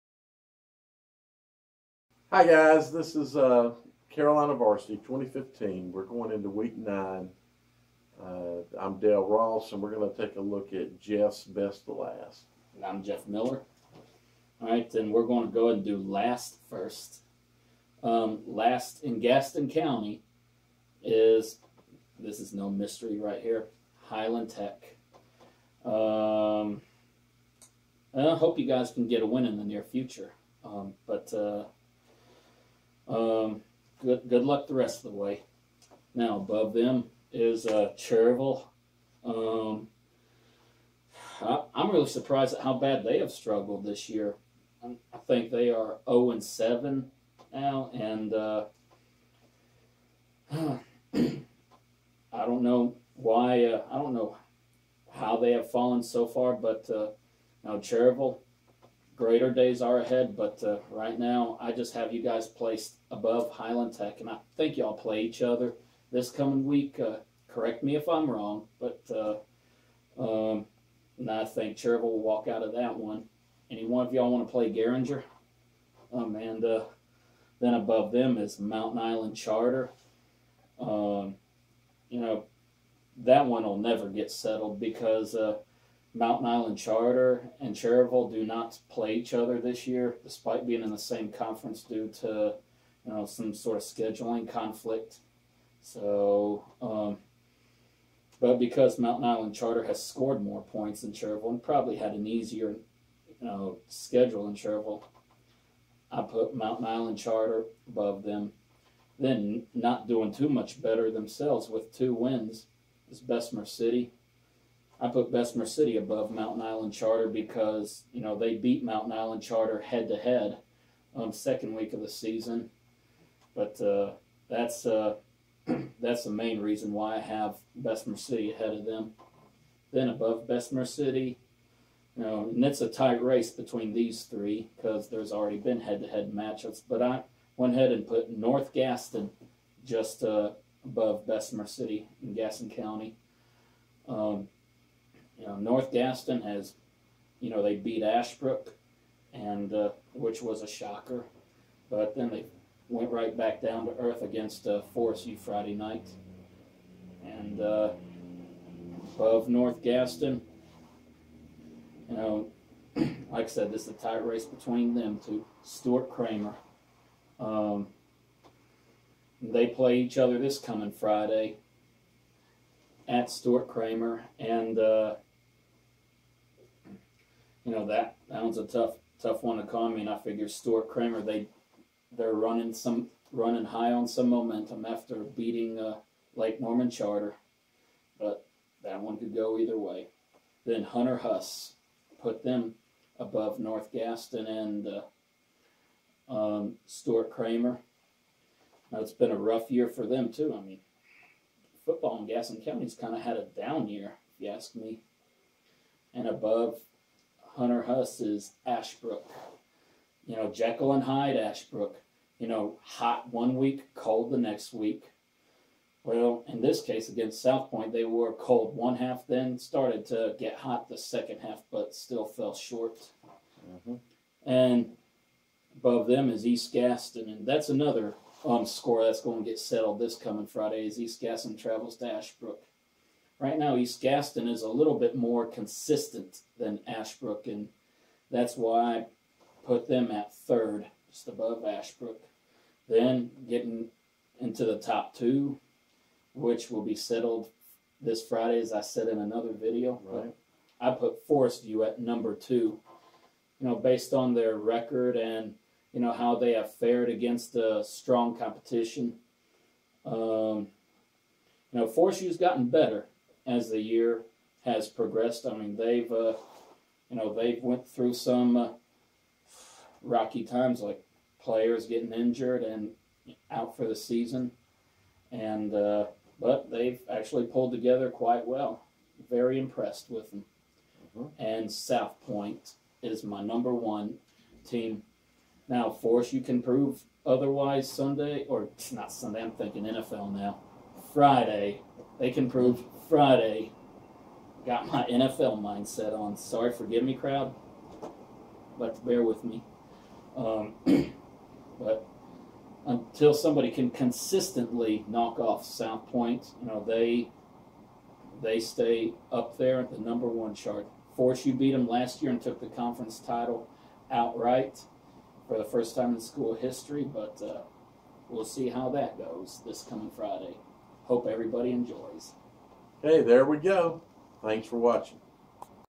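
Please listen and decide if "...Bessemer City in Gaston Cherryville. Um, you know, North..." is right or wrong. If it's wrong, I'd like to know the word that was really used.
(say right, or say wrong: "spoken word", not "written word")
wrong: "County", not "Cherryville".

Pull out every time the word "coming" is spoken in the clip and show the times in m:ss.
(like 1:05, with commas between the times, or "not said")
1:06, 2:50, 3:50, 5:19.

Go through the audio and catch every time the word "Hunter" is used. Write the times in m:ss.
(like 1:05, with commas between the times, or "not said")
3:10, 3:27.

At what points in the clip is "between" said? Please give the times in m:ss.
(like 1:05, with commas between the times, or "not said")
2:13, 2:44.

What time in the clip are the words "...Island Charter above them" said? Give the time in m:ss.
1:46.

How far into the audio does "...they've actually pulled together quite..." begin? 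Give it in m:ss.
4:36.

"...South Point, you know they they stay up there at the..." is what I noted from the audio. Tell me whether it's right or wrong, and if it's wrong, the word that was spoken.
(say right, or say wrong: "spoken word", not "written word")
right.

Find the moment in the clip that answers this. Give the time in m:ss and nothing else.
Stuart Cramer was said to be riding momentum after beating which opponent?
3:06.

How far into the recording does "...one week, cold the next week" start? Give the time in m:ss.
3:33.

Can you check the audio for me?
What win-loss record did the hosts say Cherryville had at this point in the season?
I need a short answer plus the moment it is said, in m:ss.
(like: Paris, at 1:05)
0 and 7, at 0:46.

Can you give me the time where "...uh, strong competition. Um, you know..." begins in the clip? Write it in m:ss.
4:17.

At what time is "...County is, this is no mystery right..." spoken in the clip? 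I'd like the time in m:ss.
0:19.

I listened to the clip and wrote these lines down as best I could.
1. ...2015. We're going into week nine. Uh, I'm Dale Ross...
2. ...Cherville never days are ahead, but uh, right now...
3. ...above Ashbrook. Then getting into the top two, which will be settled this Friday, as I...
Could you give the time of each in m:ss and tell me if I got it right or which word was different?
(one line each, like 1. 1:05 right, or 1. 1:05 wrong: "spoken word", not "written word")
1. 0:05 right
2. 0:57 wrong: "greater", not "never"
3. 4:01 right.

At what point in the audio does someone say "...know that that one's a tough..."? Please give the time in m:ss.
2:57.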